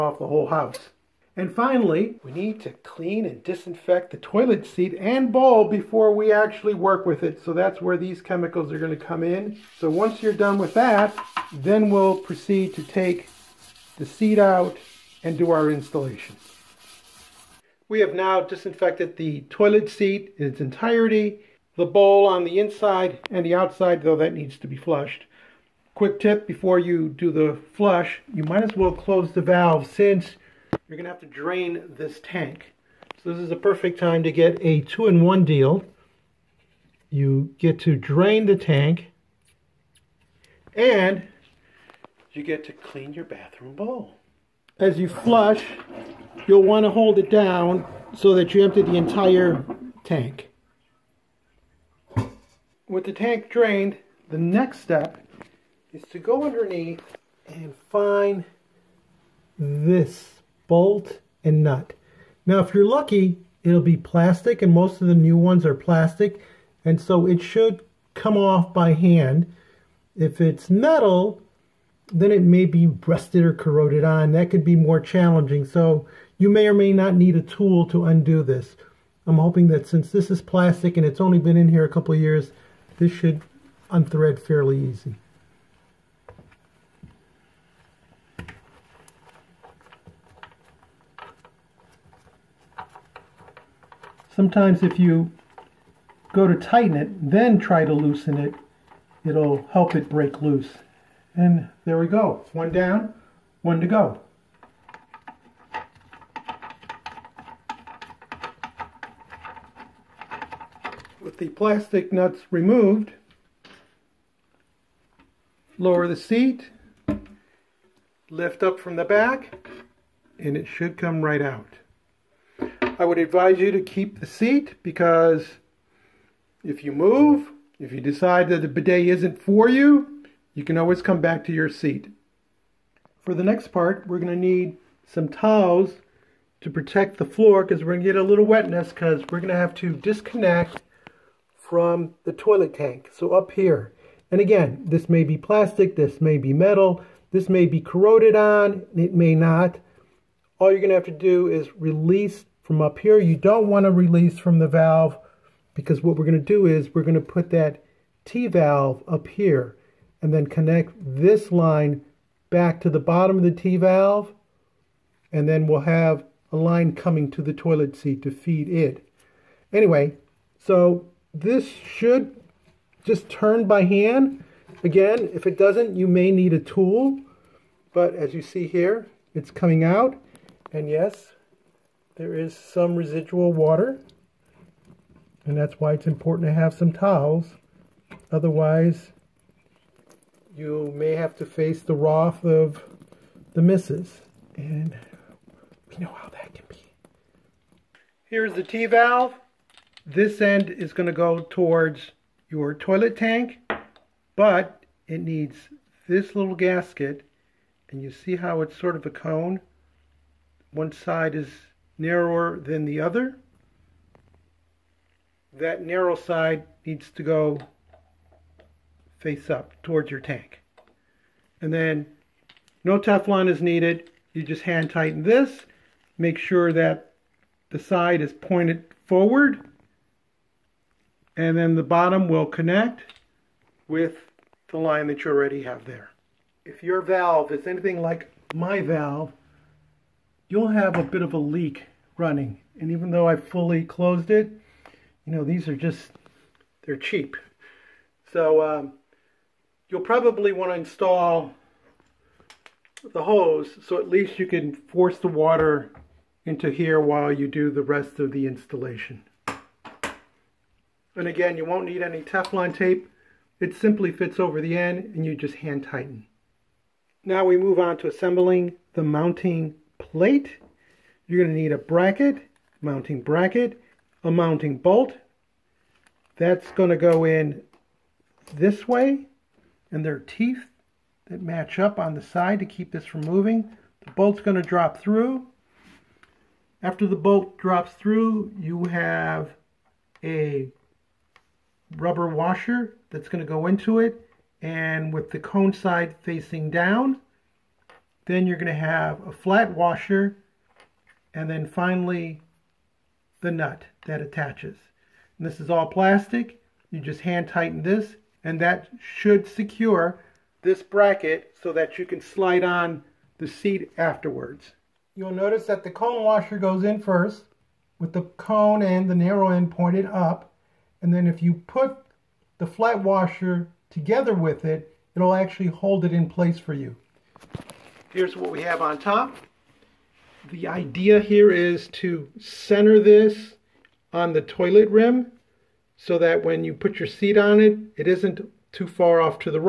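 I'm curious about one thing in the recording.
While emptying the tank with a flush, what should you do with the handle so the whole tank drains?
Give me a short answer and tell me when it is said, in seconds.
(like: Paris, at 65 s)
Hold it down, at 46 s.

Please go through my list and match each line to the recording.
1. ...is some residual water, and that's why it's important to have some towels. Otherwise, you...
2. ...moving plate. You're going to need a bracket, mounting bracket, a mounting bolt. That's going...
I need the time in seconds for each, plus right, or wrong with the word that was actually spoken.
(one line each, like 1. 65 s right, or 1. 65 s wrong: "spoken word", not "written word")
1. 182 s right
2. 269 s wrong: "mounting", not "moving".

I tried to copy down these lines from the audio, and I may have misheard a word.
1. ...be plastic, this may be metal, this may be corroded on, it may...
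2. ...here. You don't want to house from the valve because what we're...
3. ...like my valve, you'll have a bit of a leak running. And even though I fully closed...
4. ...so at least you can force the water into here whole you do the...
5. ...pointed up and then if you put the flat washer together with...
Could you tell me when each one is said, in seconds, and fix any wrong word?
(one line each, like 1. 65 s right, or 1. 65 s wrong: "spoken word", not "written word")
1. 145 s right
2. 152 s wrong: "release", not "house"
3. 238 s right
4. 253 s wrong: "while", not "whole"
5. 319 s right.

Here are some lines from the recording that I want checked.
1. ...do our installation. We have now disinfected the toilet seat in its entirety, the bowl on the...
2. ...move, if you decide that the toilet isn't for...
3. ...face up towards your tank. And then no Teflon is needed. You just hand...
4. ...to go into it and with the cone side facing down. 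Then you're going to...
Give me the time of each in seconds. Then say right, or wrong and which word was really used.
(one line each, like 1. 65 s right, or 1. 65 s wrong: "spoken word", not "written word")
1. 15 s right
2. 126 s wrong: "bidet", not "toilet"
3. 219 s right
4. 293 s right.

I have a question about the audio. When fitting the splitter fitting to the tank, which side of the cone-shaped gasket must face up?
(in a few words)
Narrow side.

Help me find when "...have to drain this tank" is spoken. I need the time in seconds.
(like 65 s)
31 s.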